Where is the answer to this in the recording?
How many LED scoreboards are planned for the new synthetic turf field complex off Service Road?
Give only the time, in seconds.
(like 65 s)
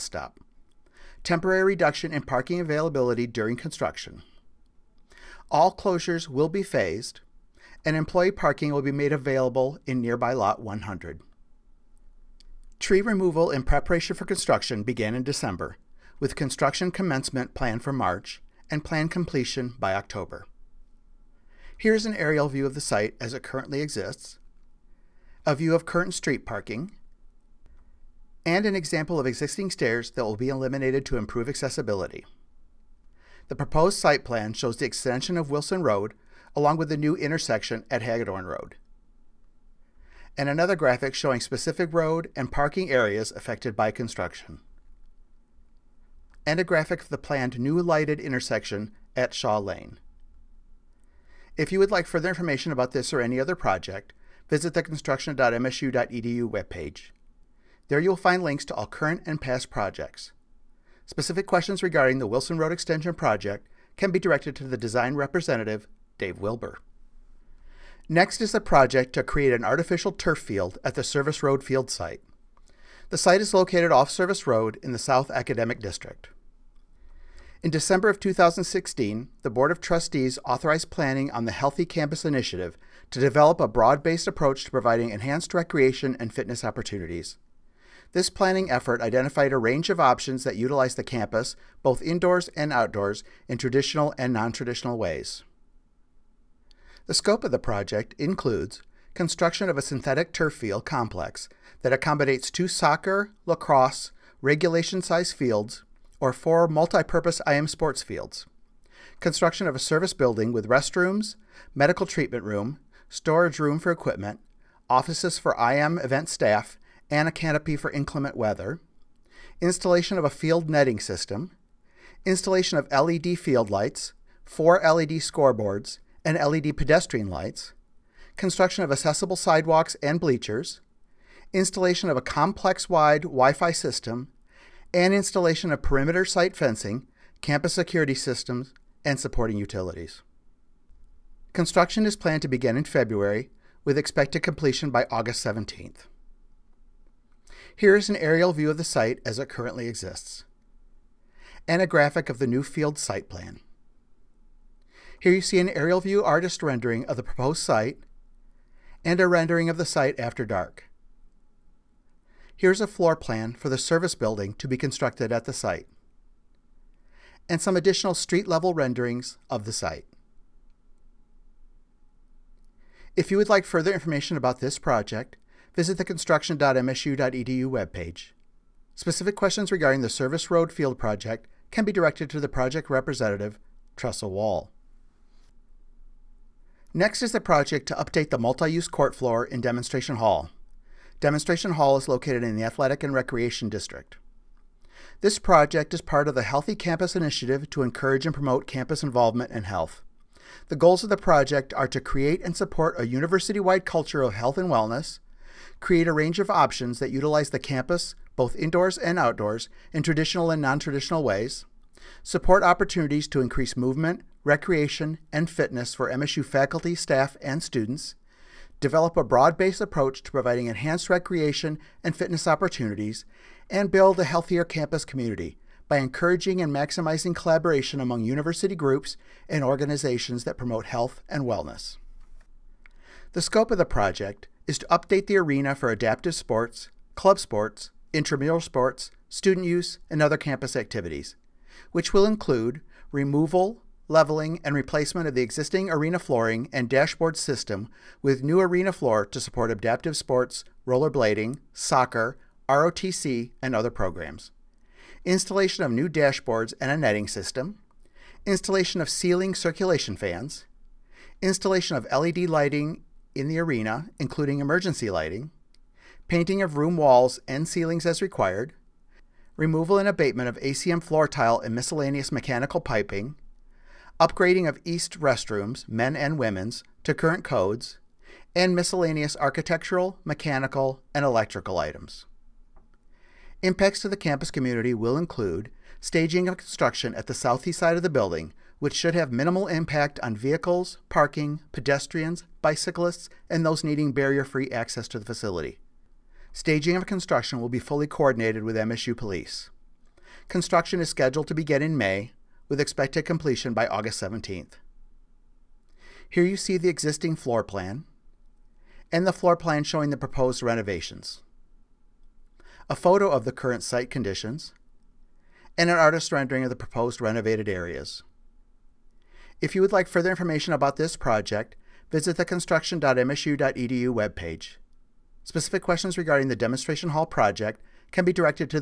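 124 s.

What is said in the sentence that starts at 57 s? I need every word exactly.
There you will find links to all current and past projects.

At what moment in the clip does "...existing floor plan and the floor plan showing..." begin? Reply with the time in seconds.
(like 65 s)
306 s.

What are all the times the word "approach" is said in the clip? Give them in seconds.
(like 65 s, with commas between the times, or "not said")
84 s, 219 s.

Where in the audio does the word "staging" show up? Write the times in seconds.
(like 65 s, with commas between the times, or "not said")
285 s, 296 s.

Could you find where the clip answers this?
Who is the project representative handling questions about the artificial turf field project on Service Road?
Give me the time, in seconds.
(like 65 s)
183 s.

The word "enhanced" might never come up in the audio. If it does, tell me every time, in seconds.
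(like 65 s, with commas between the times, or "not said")
85 s, 220 s.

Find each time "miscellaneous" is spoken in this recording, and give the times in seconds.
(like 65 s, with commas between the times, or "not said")
271 s, 278 s.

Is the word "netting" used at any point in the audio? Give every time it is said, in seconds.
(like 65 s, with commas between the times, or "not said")
120 s, 256 s.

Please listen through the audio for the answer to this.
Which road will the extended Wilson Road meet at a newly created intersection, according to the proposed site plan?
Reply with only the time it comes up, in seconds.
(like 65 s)
38 s.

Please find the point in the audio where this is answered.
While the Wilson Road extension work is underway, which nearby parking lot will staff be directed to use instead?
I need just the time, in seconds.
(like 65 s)
10 s.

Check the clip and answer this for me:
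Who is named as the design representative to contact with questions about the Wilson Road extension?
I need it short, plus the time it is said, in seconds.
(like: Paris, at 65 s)
Dave Wilbur, at 66 s.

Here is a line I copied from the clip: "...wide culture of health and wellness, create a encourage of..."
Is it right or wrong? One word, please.
wrong.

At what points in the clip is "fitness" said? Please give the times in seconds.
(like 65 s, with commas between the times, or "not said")
86 s, 215 s, 222 s.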